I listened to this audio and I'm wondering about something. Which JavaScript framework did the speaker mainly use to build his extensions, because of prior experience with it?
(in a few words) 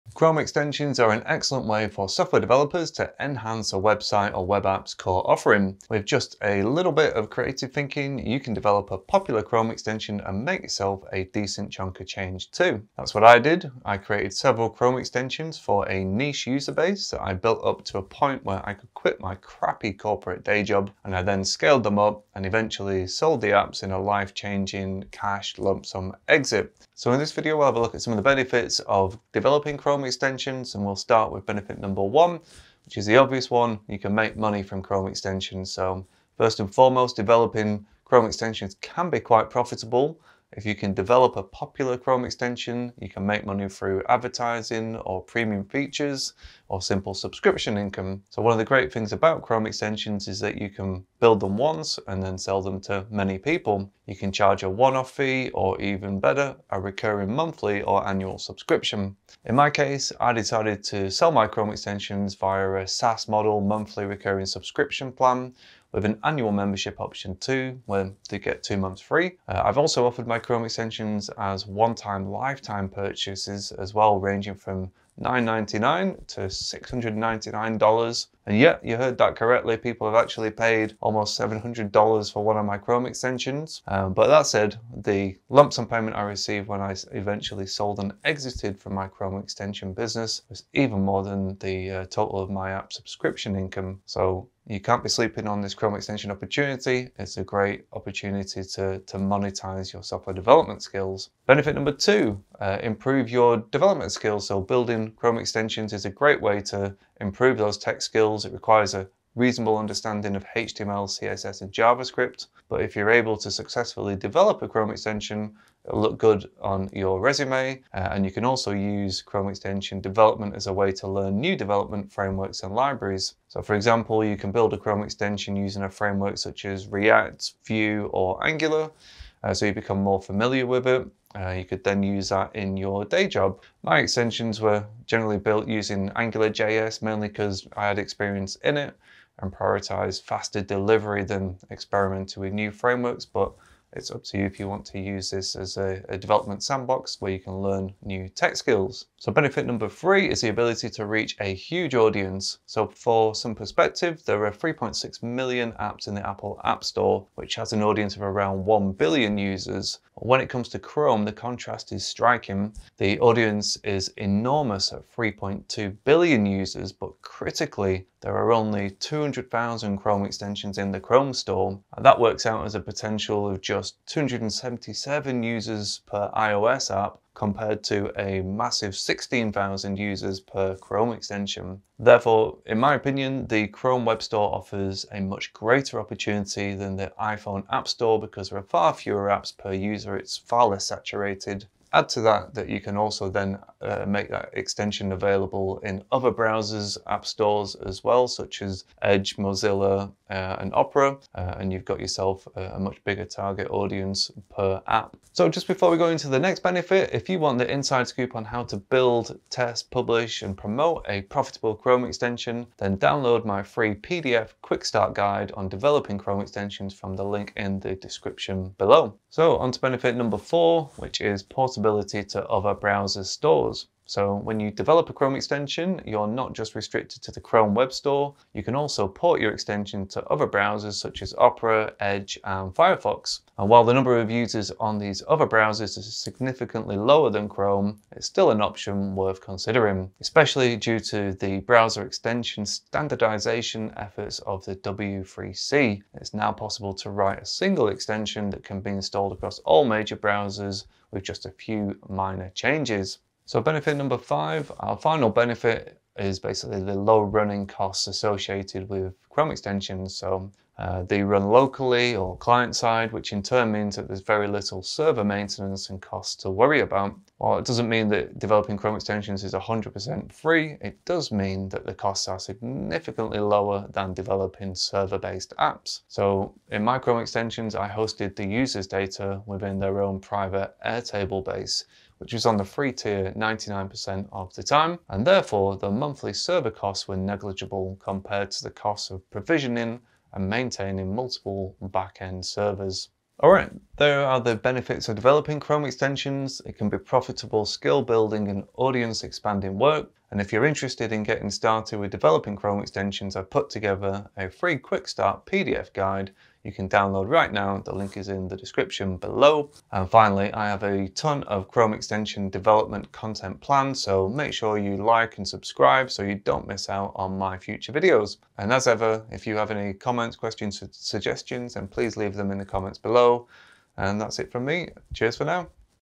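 AngularJS.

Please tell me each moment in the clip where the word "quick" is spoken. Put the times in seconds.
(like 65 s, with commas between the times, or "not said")
214 s, 304 s.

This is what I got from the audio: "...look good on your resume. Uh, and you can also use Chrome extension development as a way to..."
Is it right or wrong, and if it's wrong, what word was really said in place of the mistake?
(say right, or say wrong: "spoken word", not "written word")
right.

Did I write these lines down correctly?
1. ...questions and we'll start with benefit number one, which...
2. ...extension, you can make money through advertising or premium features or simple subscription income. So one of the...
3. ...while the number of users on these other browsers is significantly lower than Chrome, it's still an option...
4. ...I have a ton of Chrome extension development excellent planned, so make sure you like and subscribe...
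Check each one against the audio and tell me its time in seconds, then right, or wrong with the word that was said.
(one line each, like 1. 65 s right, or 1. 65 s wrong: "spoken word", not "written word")
1. 30 s wrong: "extensions", not "questions"
2. 42 s right
3. 233 s right
4. 310 s wrong: "content", not "excellent".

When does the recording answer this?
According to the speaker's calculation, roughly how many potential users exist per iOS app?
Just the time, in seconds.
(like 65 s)
174 s.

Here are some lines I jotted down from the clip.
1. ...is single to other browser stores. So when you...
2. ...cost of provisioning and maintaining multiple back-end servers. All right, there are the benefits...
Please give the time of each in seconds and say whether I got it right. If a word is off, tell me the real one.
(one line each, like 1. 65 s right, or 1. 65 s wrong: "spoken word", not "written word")
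1. 221 s wrong: "portable", not "single"
2. 288 s right.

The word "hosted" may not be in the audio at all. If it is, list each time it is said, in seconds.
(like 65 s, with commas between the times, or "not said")
277 s.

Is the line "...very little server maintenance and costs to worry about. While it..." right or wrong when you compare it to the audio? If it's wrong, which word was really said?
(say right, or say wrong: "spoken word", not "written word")
right.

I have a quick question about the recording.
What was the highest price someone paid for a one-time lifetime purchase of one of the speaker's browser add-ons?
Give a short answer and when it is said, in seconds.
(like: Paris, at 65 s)
$699, at 76 s.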